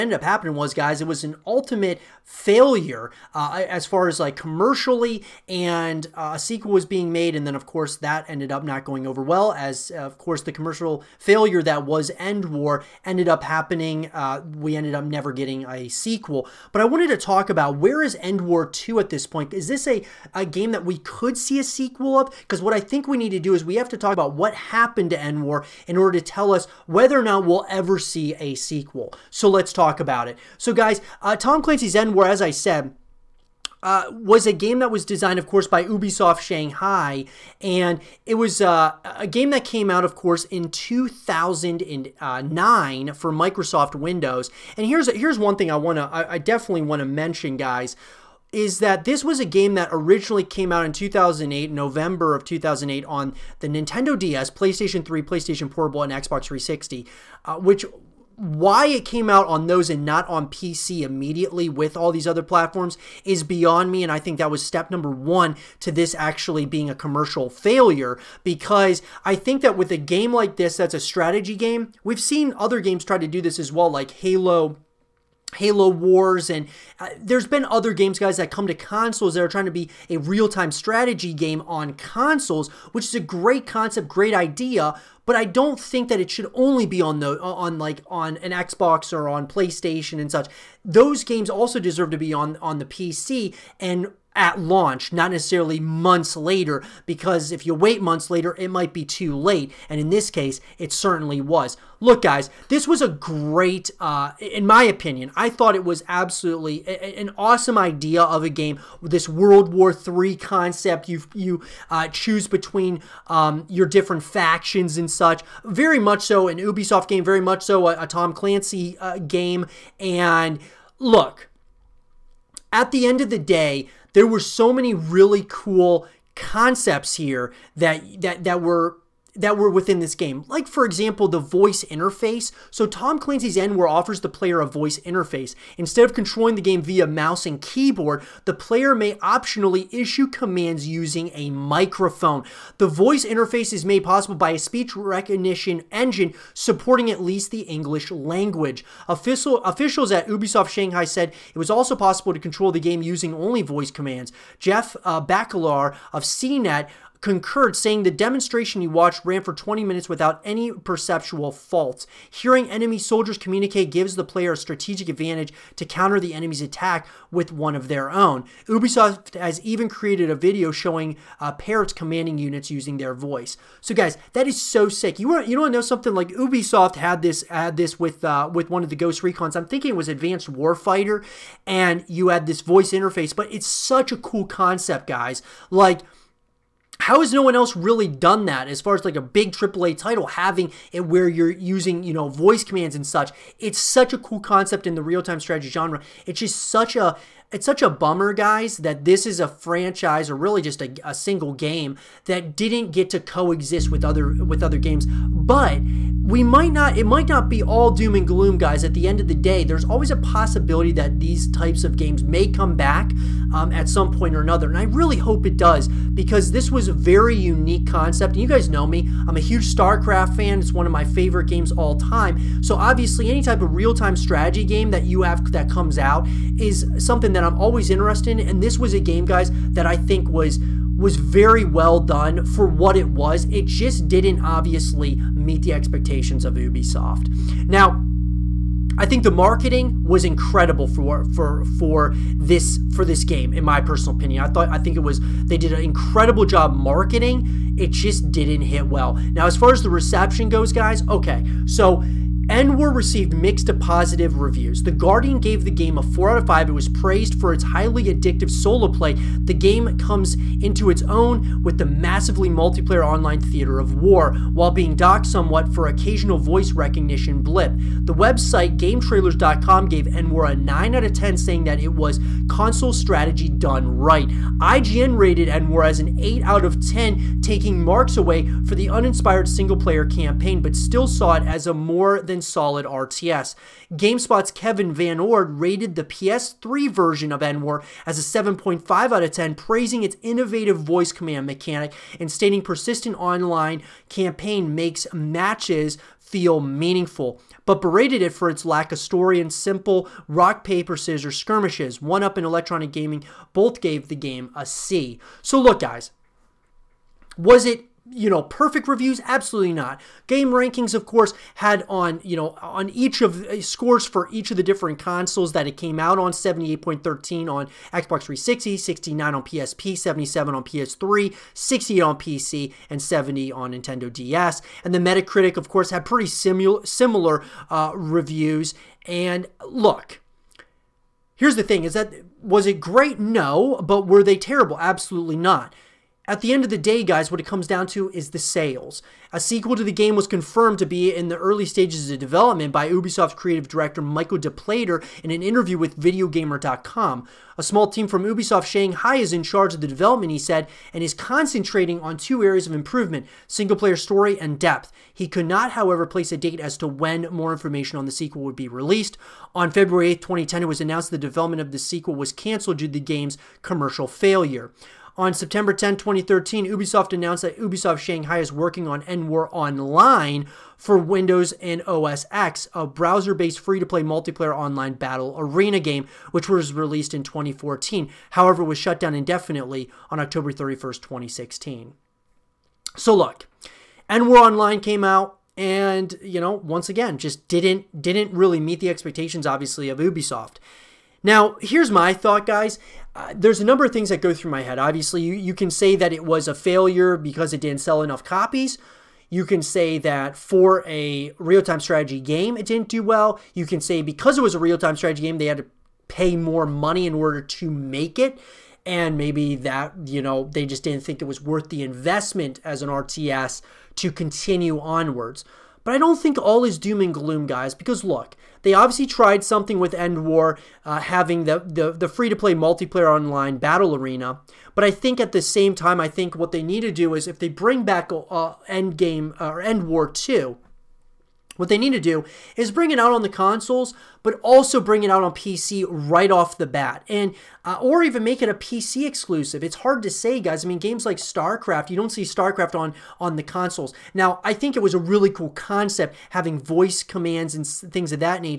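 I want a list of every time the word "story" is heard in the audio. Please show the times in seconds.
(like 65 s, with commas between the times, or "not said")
298 s, 353 s.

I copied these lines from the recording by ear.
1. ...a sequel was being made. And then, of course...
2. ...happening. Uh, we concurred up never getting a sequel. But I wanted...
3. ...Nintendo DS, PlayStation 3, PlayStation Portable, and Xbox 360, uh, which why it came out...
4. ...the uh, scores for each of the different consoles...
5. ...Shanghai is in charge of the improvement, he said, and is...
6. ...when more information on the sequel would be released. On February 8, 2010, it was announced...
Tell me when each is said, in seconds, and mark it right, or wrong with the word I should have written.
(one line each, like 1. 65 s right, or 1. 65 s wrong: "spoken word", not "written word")
1. 6 s right
2. 13 s wrong: "ended", not "concurred"
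3. 53 s right
4. 313 s right
5. 348 s wrong: "development", not "improvement"
6. 356 s right.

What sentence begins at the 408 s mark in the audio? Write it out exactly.
And maybe that, you know, they just didn't think it was worth the investment as an RTS to continue onwards.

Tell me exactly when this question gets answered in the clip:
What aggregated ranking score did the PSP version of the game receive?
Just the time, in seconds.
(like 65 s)
318 s.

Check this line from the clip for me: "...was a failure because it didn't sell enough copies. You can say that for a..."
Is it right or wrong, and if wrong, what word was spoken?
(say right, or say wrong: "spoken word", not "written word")
right.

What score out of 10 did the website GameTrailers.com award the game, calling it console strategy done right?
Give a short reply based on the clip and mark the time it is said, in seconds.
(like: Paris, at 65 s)
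9, at 270 s.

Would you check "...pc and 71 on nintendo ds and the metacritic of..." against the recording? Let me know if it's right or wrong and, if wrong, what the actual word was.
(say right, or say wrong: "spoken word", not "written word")
wrong: "70", not "71".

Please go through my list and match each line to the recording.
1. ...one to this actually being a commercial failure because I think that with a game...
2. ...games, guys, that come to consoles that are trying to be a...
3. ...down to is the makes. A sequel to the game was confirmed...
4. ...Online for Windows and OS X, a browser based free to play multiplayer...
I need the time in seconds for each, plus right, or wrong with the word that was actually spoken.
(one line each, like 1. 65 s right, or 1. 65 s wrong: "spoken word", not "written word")
1. 65 s right
2. 77 s right
3. 337 s wrong: "sales", not "makes"
4. 369 s right.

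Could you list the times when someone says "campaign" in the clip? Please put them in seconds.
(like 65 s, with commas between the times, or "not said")
280 s, 294 s.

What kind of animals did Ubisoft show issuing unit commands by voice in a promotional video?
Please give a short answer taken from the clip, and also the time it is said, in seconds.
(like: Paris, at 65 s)
Parrots, at 171 s.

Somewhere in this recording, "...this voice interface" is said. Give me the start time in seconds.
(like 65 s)
182 s.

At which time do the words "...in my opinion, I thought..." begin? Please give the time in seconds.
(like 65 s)
104 s.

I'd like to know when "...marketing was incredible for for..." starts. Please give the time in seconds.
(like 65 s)
239 s.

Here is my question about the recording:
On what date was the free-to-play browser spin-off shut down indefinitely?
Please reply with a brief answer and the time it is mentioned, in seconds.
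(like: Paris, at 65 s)
October 31, 2016, at 380 s.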